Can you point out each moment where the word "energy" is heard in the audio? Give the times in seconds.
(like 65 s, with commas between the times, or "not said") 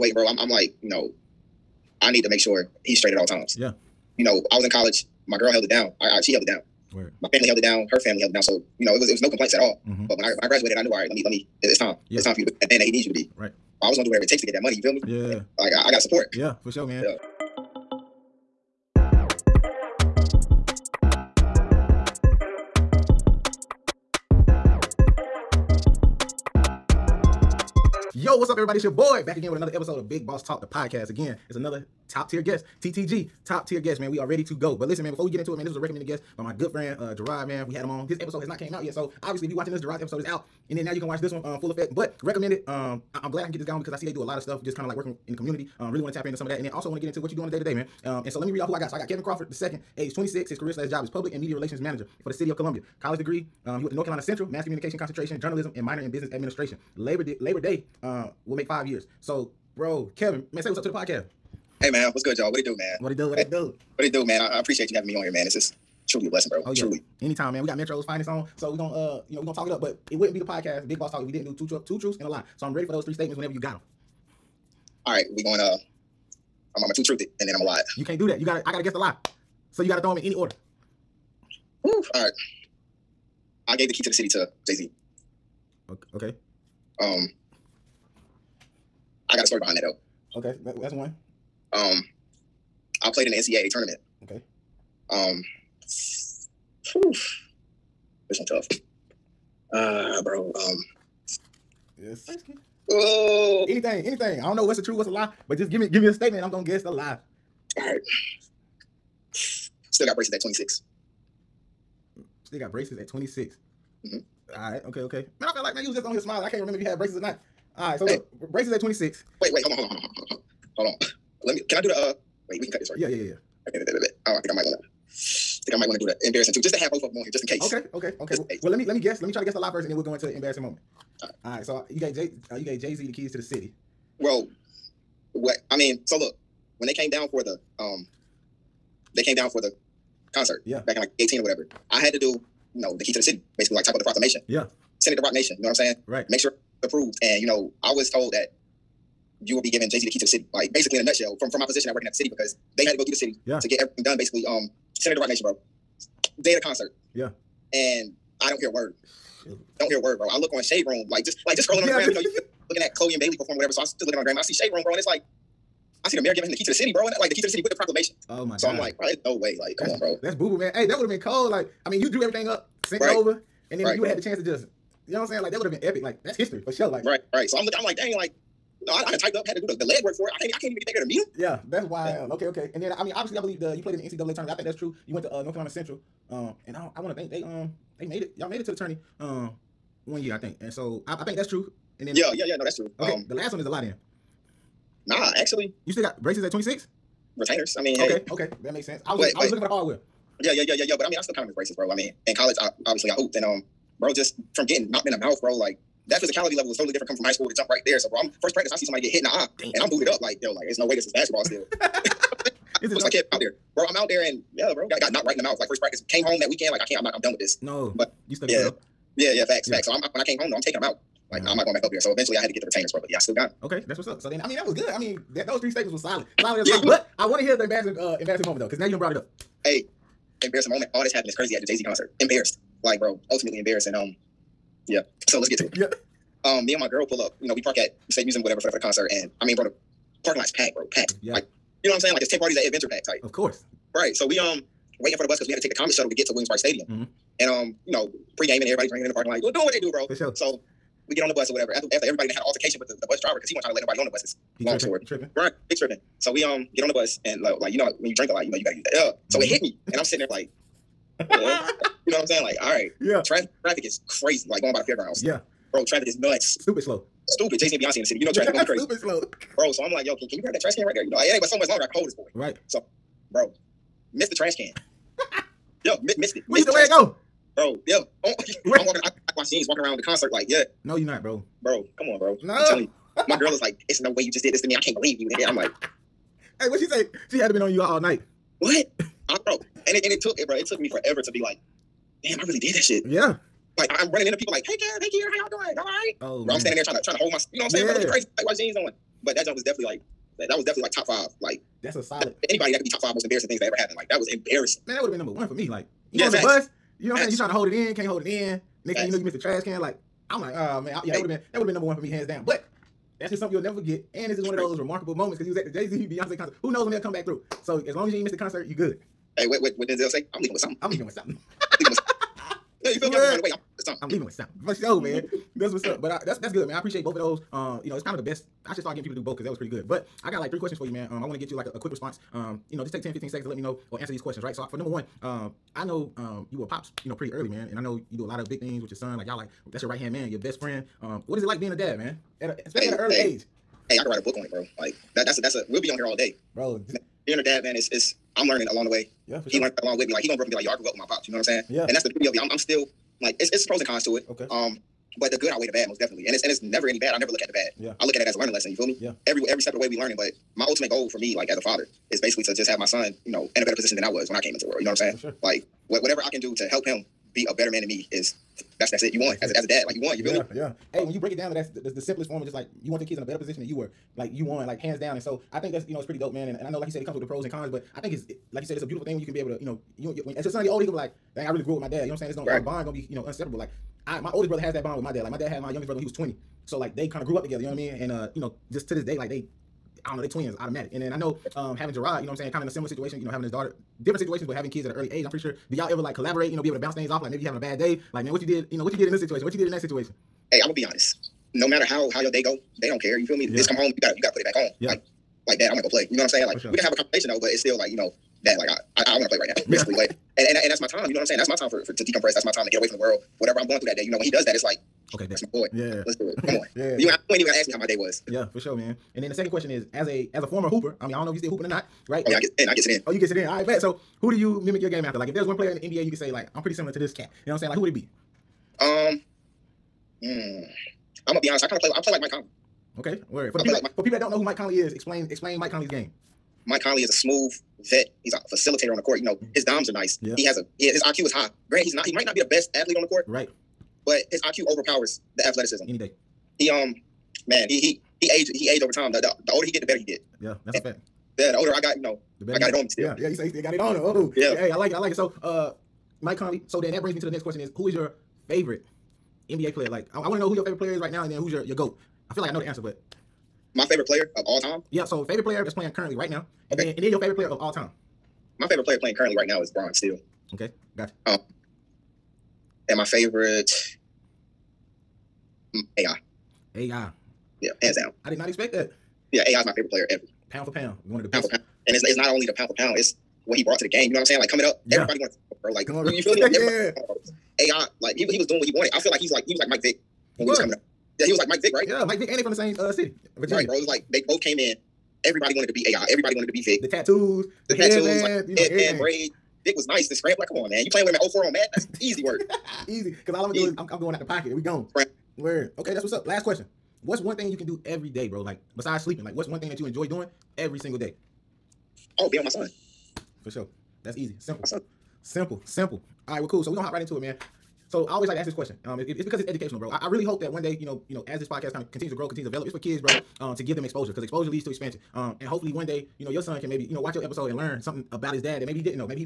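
not said.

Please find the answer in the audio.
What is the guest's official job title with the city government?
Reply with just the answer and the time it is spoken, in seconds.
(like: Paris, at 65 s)
Public and media relations manager, at 51 s.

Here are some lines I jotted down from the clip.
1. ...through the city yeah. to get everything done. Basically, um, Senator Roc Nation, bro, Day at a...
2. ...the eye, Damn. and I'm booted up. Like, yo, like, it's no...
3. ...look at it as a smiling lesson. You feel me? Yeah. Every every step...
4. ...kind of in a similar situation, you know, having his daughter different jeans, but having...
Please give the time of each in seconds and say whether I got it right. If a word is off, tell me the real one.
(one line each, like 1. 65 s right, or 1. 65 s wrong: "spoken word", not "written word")
1. 153 s right
2. 209 s right
3. 358 s wrong: "learning", not "smiling"
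4. 392 s wrong: "situations", not "jeans".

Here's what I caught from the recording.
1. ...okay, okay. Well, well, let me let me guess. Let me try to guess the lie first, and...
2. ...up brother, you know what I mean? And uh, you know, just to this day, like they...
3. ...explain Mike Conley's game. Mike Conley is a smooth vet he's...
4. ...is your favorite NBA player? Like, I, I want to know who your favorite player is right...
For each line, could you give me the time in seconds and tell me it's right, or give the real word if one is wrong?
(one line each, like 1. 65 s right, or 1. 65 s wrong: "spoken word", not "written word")
1. 127 s right
2. 387 s wrong: "together", not "brother"
3. 435 s right
4. 457 s right.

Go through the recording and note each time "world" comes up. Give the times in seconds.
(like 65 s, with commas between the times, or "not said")
364 s, 412 s.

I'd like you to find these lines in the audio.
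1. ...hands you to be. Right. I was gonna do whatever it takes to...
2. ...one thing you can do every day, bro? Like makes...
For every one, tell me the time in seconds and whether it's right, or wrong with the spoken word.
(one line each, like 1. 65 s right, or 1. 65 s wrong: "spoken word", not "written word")
1. 12 s wrong: "needs", not "hands"
2. 507 s wrong: "besides", not "makes".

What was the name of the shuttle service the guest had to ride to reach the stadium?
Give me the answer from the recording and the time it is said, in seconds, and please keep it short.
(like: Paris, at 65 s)
Comet, at 245 s.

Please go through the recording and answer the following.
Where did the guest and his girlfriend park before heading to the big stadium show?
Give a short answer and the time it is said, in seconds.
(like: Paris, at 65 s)
State Museum, at 238 s.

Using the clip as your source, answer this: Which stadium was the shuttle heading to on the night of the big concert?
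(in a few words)
Williams-Brice Stadium.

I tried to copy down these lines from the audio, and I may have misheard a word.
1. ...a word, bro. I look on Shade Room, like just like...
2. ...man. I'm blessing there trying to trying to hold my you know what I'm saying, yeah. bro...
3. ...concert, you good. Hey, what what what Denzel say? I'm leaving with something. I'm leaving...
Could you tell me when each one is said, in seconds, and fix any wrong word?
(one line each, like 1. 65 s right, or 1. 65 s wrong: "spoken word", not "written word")
1. 159 s right
2. 296 s wrong: "standing", not "blessing"
3. 318 s right.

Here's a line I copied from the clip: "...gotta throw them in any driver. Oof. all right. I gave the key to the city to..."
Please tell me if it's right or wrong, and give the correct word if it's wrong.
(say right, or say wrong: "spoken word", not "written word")
wrong: "order", not "driver".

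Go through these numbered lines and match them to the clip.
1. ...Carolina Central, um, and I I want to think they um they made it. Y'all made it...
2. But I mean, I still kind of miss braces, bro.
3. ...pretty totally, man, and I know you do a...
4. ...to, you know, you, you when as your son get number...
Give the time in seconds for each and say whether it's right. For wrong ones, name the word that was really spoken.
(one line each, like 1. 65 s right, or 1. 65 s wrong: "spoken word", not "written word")
1. 185 s right
2. 200 s right
3. 337 s wrong: "early", not "totally"
4. 379 s wrong: "older", not "number".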